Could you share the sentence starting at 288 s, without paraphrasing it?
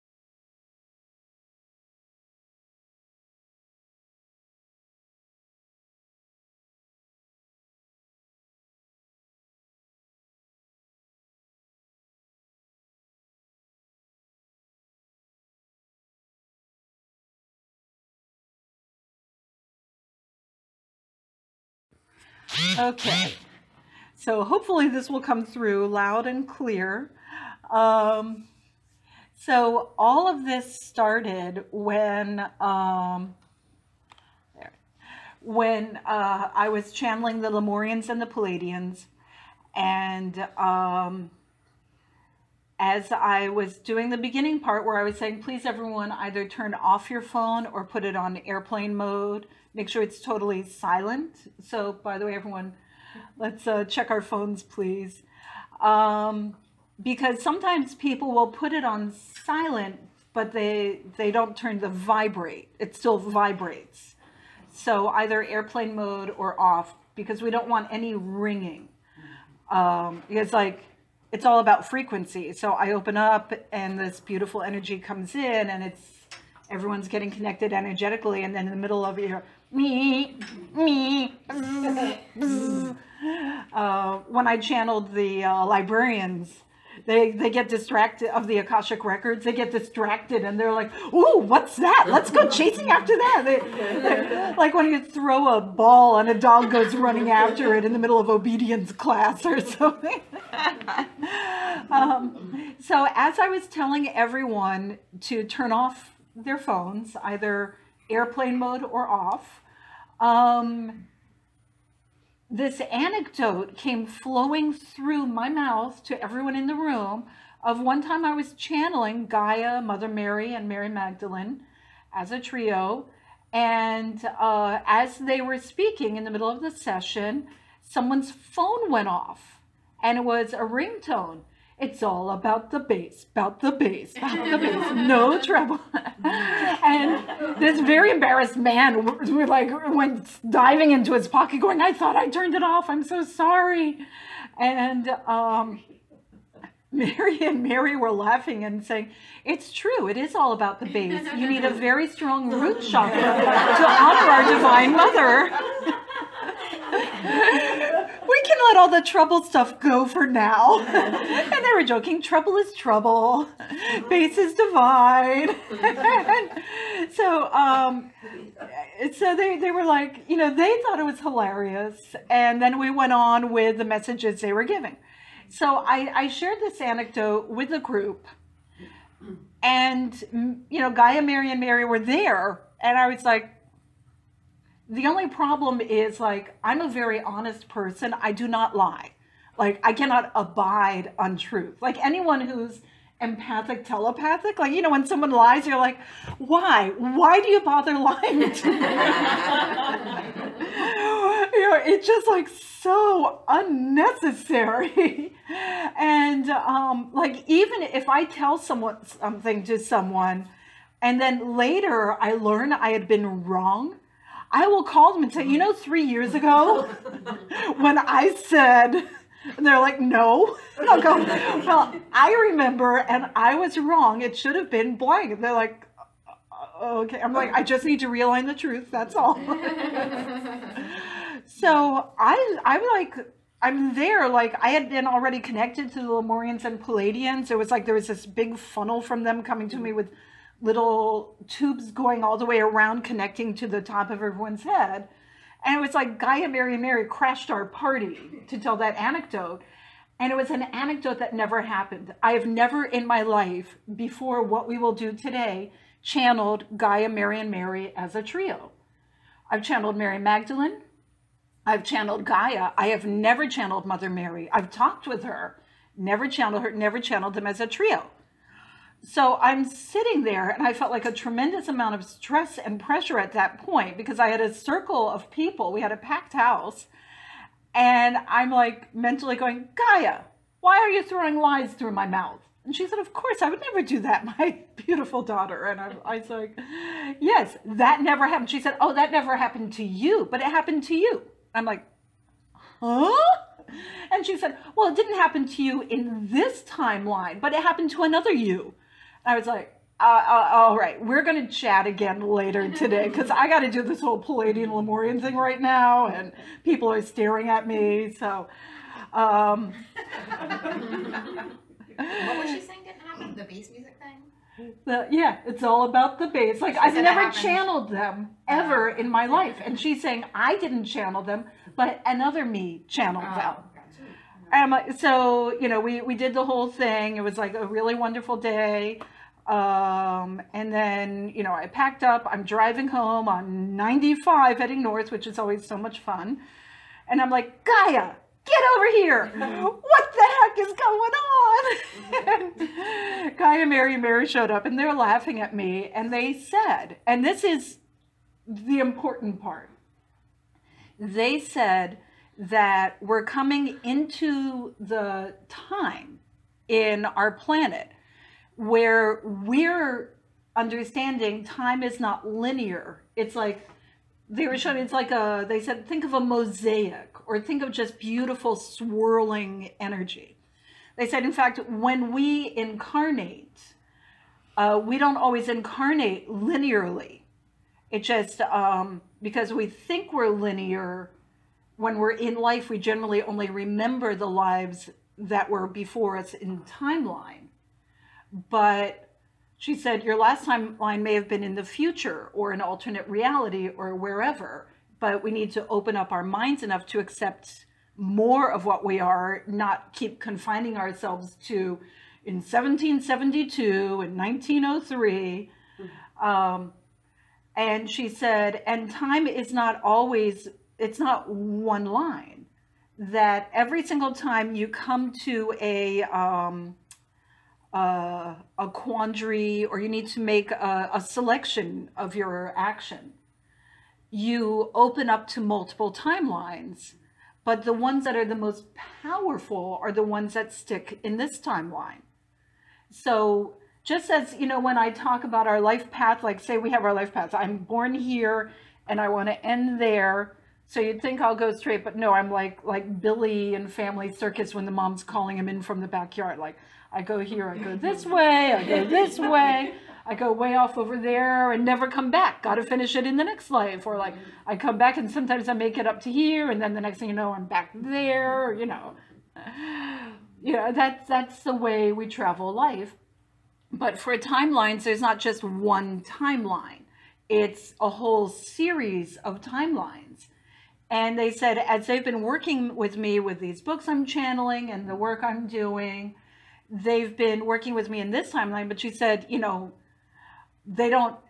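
She said, Oh, that never happened to you, but it happened to you.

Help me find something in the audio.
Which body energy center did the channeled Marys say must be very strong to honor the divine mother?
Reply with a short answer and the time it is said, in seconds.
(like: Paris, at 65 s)
root chakra, at 152 s.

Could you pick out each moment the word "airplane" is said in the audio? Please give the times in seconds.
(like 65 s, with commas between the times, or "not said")
48 s, 65 s, 108 s.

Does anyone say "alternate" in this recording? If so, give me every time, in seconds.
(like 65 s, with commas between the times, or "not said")
392 s.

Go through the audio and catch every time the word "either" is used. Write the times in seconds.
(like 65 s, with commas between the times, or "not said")
46 s, 65 s, 107 s.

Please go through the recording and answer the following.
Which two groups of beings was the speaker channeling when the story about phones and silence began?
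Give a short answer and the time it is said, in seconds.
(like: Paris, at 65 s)
Lemurians and Pleiadians, at 37 s.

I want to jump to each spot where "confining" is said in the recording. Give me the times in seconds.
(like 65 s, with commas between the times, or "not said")
400 s.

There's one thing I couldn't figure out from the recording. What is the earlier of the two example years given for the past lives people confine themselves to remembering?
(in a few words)
1772.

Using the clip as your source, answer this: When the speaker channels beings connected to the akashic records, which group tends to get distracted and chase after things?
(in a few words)
librarians.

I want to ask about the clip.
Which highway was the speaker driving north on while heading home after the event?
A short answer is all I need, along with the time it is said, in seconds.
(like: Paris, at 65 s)
95, at 333 s.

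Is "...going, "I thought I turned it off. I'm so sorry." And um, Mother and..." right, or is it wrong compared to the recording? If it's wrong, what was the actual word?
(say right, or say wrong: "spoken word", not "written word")
wrong: "Mary", not "Mother".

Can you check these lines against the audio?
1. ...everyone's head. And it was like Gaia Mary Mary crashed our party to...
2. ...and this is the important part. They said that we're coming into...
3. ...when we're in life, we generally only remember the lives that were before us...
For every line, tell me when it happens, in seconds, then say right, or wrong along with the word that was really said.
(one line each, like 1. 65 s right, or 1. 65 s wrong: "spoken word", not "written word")
1. 244 s right
2. 347 s right
3. 381 s right.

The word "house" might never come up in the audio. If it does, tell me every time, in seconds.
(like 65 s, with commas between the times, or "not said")
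276 s.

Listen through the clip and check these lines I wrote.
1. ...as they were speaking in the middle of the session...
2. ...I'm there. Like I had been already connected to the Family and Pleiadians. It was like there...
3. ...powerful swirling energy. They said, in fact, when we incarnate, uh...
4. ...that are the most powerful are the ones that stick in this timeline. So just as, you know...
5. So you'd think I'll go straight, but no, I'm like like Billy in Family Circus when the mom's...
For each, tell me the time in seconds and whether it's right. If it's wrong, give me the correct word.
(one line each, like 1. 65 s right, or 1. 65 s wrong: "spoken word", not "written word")
1. 124 s right
2. 233 s wrong: "Lemurians", not "Family"
3. 367 s wrong: "beautiful", not "powerful"
4. 428 s right
5. 440 s right.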